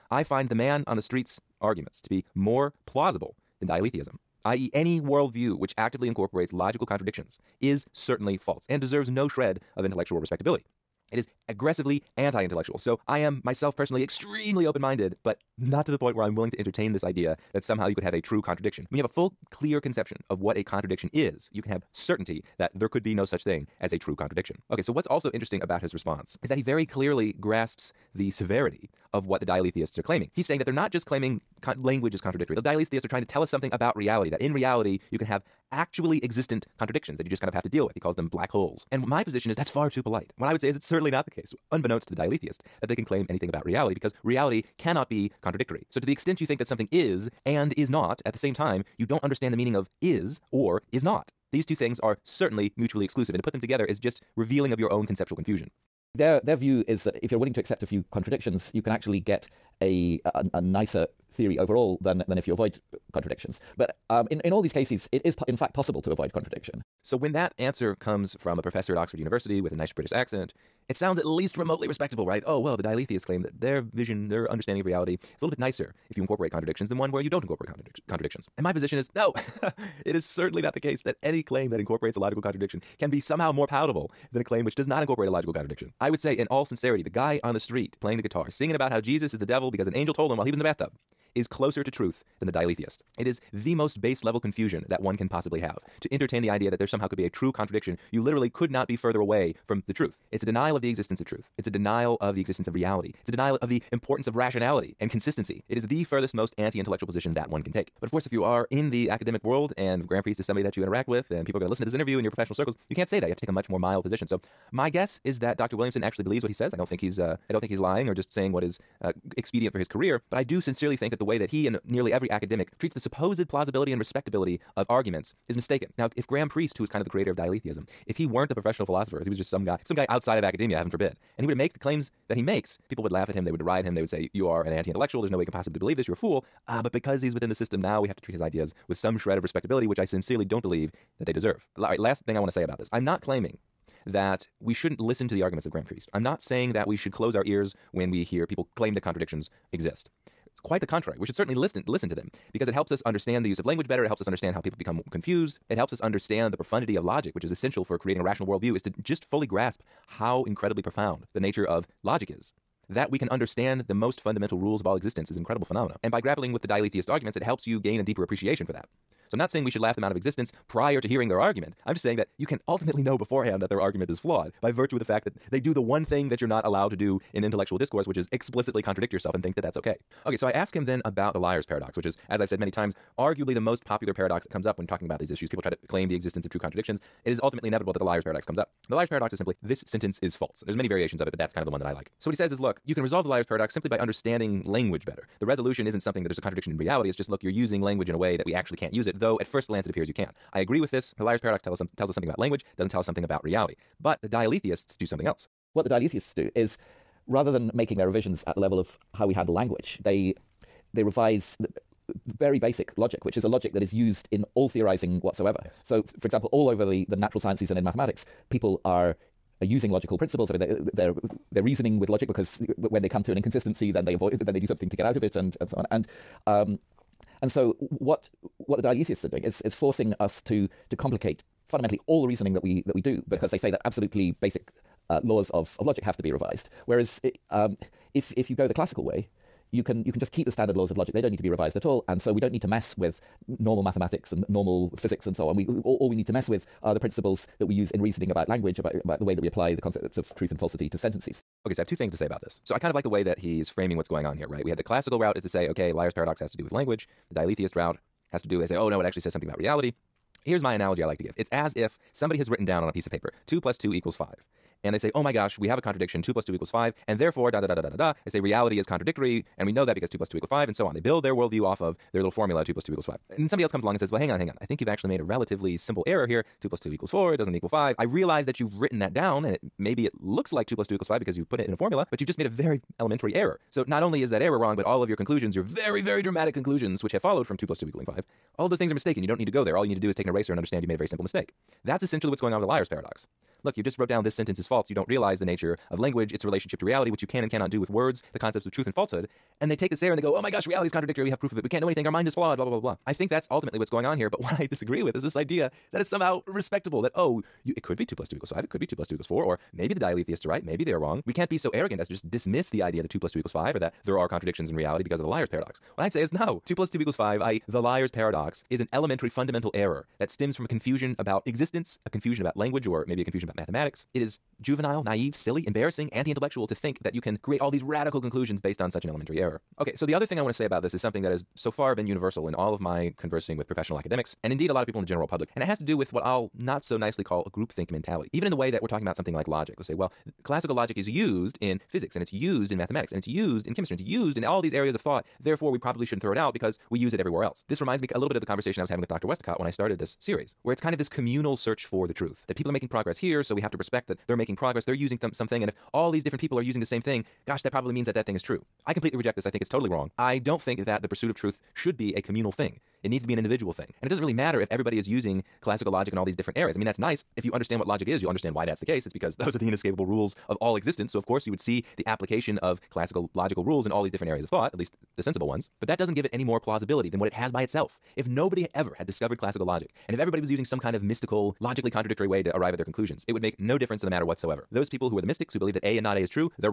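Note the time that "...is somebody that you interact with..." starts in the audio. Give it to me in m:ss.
1:50.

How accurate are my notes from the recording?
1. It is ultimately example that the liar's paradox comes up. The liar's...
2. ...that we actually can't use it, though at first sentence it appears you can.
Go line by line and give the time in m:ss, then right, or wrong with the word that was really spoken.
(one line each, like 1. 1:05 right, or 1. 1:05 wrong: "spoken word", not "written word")
1. 3:07 wrong: "inevitable", not "example"
2. 3:18 wrong: "glance", not "sentence".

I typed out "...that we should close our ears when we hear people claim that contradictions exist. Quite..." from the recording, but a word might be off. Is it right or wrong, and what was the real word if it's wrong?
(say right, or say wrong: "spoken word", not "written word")
right.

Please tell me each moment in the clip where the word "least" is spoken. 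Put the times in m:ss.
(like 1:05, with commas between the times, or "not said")
1:11, 6:14.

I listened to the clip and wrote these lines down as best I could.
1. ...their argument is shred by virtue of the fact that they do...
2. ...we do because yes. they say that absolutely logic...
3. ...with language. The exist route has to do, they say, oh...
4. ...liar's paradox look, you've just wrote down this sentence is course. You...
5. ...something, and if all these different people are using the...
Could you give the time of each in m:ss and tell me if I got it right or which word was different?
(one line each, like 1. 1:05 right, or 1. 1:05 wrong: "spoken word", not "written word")
1. 2:53 wrong: "flawed", not "shred"
2. 3:52 wrong: "basic", not "logic"
3. 4:16 wrong: "dialetheist", not "exist"
4. 4:52 wrong: "false", not "course"
5. 5:55 right.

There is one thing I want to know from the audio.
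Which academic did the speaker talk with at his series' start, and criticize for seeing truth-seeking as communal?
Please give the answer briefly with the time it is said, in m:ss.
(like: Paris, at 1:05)
Dr. Westacott, at 5:49.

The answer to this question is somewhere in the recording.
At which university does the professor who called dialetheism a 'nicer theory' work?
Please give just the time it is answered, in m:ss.
1:08.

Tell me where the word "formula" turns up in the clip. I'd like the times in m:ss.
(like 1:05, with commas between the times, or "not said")
4:32, 4:41.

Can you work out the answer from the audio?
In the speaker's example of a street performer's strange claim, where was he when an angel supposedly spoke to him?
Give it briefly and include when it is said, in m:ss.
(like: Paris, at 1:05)
In the bathtub, at 1:30.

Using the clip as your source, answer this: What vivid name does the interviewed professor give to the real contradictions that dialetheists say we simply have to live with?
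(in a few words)
Black holes.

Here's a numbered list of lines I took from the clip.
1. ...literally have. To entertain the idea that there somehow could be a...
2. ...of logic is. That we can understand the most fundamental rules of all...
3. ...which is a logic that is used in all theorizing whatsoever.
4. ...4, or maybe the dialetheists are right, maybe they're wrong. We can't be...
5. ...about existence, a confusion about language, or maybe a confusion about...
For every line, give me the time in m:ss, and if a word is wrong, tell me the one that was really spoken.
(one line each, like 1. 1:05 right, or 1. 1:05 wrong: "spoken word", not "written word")
1. 1:35 wrong: "possibly", not "literally"
2. 2:41 right
3. 3:33 right
4. 5:09 right
5. 5:21 right.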